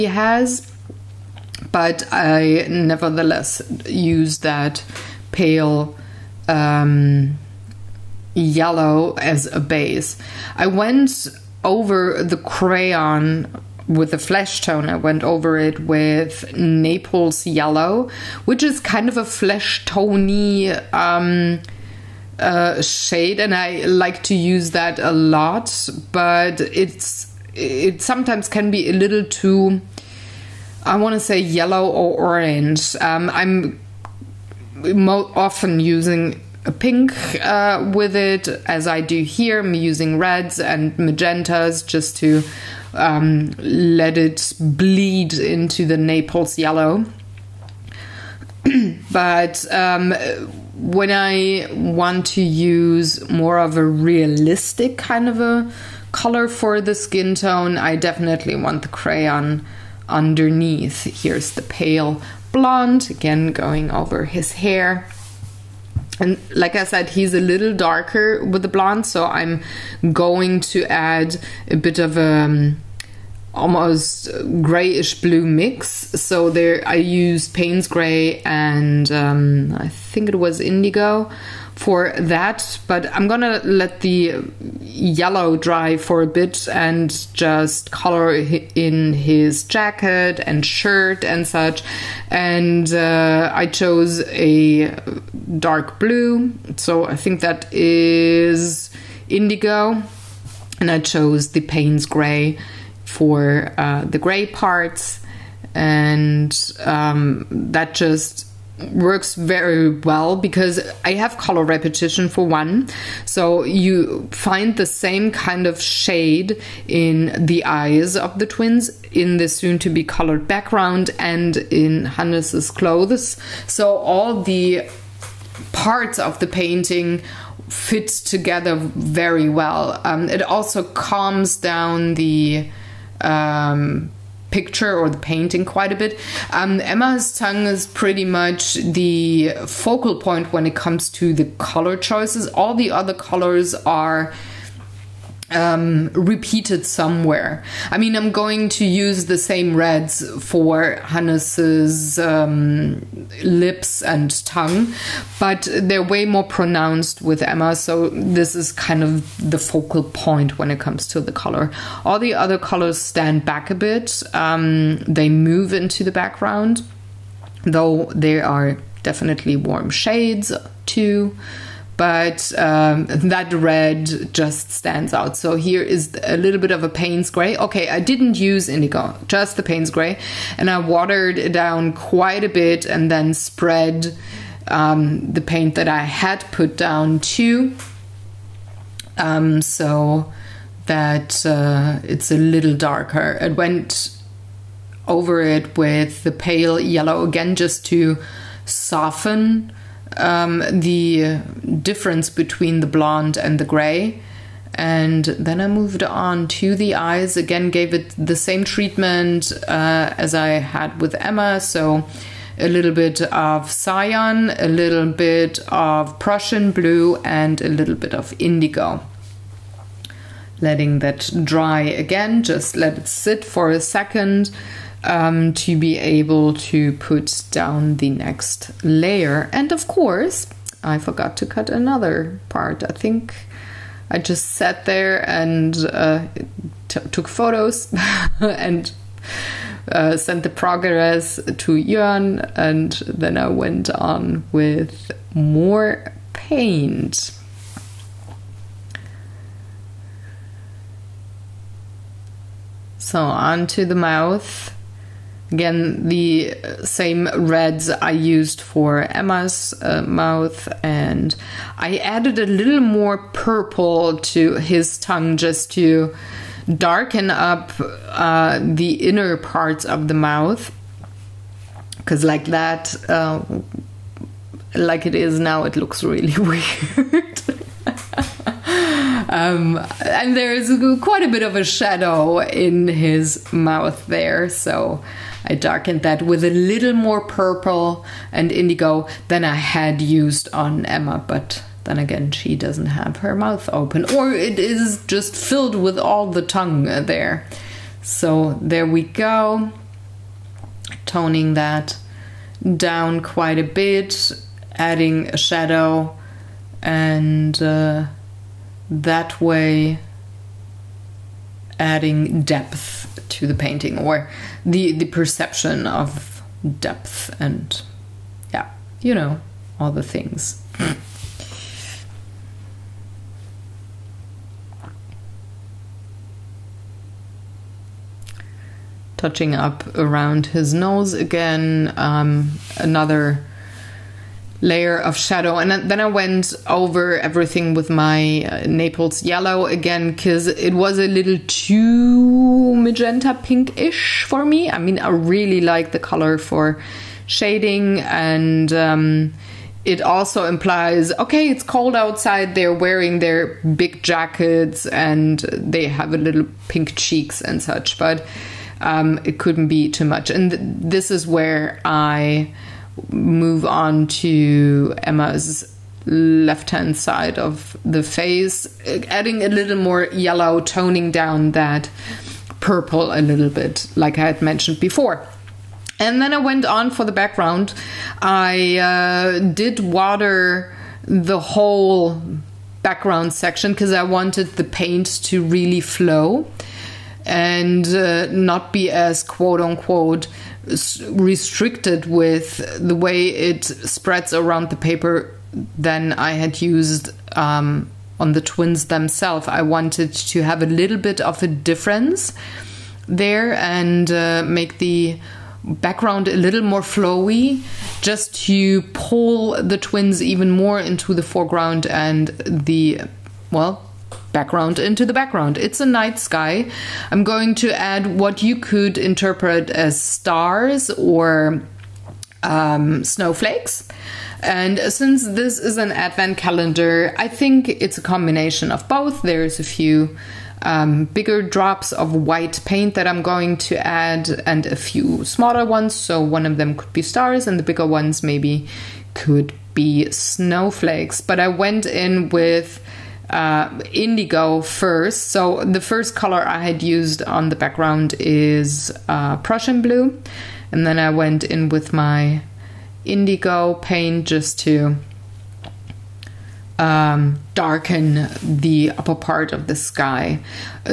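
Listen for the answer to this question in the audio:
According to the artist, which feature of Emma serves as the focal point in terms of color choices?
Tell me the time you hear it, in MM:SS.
02:16.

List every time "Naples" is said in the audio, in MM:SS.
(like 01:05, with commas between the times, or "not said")
00:16, 00:45, 05:38.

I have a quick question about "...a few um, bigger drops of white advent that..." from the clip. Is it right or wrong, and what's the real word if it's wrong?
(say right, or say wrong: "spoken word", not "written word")
wrong: "paint", not "advent".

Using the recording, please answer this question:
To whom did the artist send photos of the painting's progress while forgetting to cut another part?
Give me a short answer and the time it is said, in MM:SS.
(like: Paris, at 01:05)
Jörn, at 04:01.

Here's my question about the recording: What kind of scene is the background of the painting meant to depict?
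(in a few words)
A night sky.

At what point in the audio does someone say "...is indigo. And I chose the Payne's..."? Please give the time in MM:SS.
01:37.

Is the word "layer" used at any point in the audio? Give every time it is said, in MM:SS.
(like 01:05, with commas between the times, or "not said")
03:48, 05:34.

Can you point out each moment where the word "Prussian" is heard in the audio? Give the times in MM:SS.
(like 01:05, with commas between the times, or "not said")
03:36, 07:29.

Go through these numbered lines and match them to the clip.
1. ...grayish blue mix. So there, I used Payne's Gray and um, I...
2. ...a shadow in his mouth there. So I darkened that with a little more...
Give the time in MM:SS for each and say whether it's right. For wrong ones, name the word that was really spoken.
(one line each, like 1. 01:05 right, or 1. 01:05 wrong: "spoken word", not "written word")
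1. 01:14 right
2. 04:41 right.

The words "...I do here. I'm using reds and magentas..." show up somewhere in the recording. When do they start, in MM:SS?
00:38.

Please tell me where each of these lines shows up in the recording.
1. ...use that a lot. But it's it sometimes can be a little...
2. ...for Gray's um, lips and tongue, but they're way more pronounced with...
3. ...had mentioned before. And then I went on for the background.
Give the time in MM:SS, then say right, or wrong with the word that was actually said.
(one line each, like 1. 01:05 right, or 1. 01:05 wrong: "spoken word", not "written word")
1. 00:24 right
2. 02:30 wrong: "Hannes", not "Gray"
3. 06:14 right.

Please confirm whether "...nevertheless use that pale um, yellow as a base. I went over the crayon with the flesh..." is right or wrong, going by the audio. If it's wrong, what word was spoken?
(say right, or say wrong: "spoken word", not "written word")
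right.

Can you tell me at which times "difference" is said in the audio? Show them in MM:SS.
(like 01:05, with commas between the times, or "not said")
03:21, 06:41.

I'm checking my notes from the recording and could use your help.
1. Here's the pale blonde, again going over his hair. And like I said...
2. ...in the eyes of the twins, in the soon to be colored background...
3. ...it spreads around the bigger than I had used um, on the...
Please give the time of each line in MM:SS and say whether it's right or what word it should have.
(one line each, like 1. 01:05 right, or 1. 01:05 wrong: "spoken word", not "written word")
1. 01:01 right
2. 01:56 right
3. 06:33 wrong: "paper", not "bigger".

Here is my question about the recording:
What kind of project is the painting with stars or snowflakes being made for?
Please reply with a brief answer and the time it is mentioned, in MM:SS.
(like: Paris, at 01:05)
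An advent calendar, at 07:05.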